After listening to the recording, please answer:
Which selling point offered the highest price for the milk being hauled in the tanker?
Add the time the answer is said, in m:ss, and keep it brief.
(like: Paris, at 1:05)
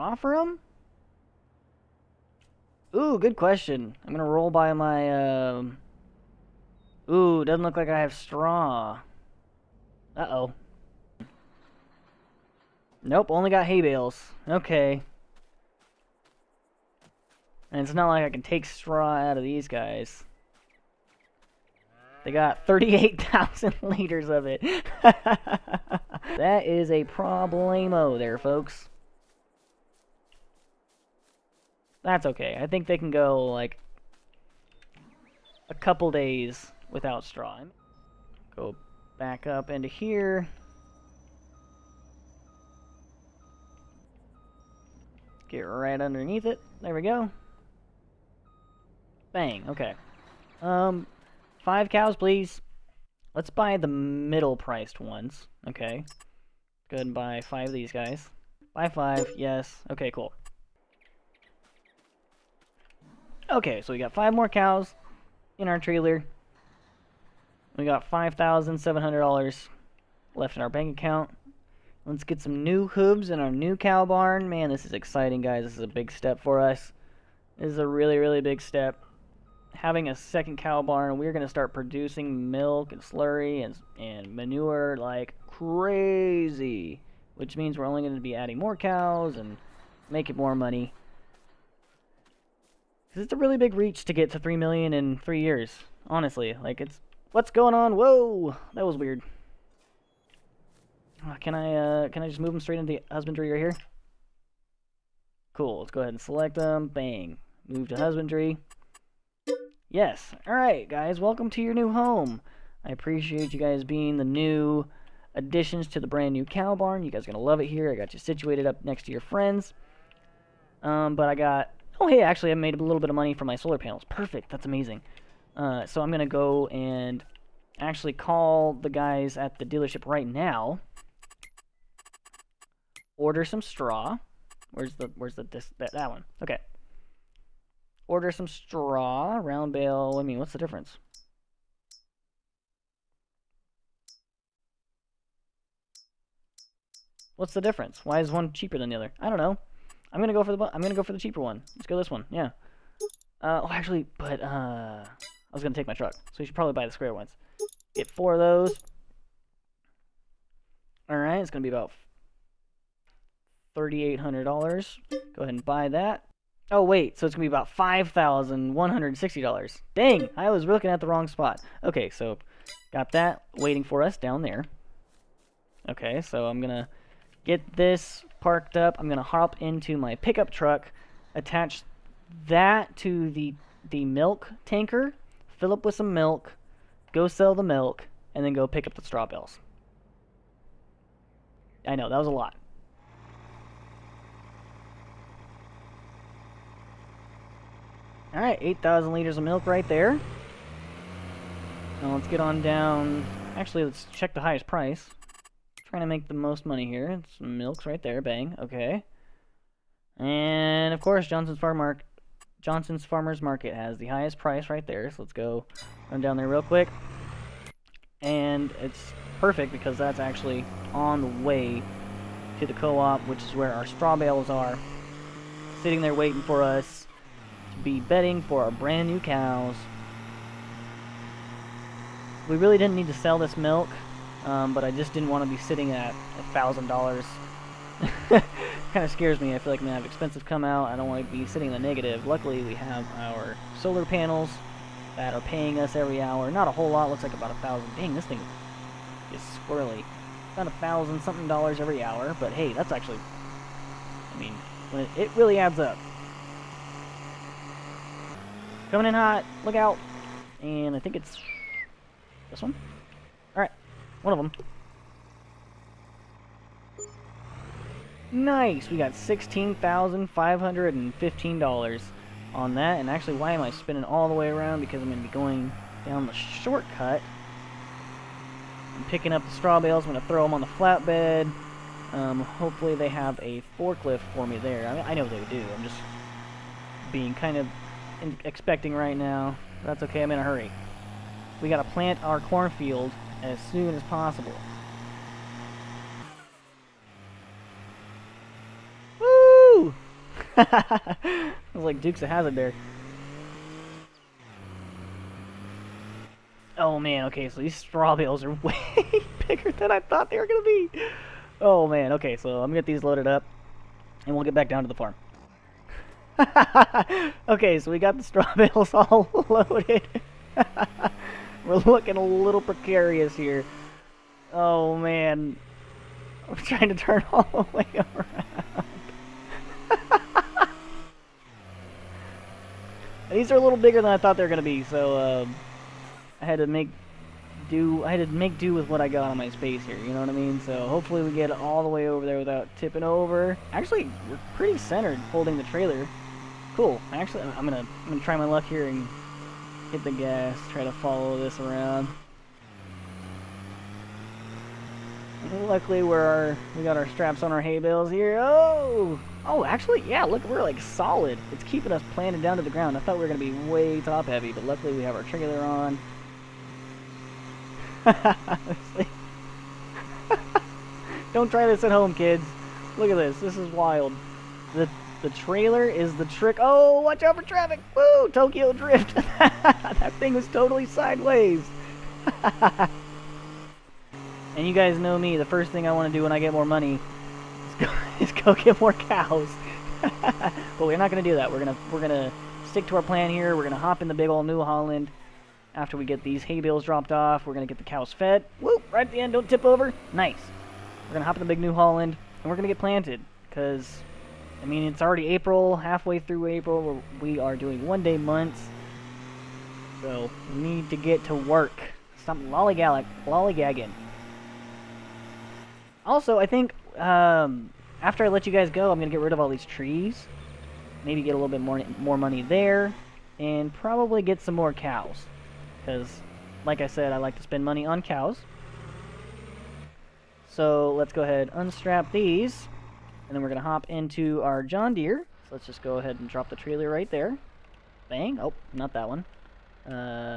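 Johnson's Farmers Market, at 3:32.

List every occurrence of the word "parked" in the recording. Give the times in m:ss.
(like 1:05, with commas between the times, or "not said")
2:58.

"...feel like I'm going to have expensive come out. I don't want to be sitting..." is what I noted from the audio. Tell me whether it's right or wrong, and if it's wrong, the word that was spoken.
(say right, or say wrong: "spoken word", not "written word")
right.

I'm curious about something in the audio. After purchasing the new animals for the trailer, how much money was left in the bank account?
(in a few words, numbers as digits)
$5,700.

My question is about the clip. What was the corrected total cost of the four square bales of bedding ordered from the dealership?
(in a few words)
$5,160.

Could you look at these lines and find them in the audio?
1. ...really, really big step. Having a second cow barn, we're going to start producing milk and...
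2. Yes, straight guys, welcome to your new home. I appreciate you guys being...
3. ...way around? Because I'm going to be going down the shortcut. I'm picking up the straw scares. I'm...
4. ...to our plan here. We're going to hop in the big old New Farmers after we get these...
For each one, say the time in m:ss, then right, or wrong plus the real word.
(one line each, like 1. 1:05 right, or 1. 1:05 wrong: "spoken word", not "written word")
1. 1:17 right
2. 1:49 wrong: "alright", not "straight"
3. 4:34 wrong: "bales", not "scares"
4. 6:32 wrong: "Holland", not "Farmers".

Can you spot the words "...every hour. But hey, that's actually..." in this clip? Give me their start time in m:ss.
4:11.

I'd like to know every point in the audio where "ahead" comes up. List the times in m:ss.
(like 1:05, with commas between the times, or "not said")
0:56, 1:46, 2:45, 7:11, 7:15.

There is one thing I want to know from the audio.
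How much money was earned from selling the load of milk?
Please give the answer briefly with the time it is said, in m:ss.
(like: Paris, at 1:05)
$16,515, at 4:29.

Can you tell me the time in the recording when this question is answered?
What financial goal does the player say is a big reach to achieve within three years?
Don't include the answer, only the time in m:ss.
1:34.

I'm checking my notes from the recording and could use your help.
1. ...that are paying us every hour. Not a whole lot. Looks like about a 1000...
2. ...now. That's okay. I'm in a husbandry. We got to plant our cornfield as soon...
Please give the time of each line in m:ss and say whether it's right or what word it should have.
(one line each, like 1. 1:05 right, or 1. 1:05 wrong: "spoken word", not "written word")
1. 4:05 right
2. 4:49 wrong: "hurry", not "husbandry".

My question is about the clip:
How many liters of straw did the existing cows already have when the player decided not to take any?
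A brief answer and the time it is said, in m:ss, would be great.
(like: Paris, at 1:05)
38,000, at 0:22.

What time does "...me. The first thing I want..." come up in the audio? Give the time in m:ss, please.
6:25.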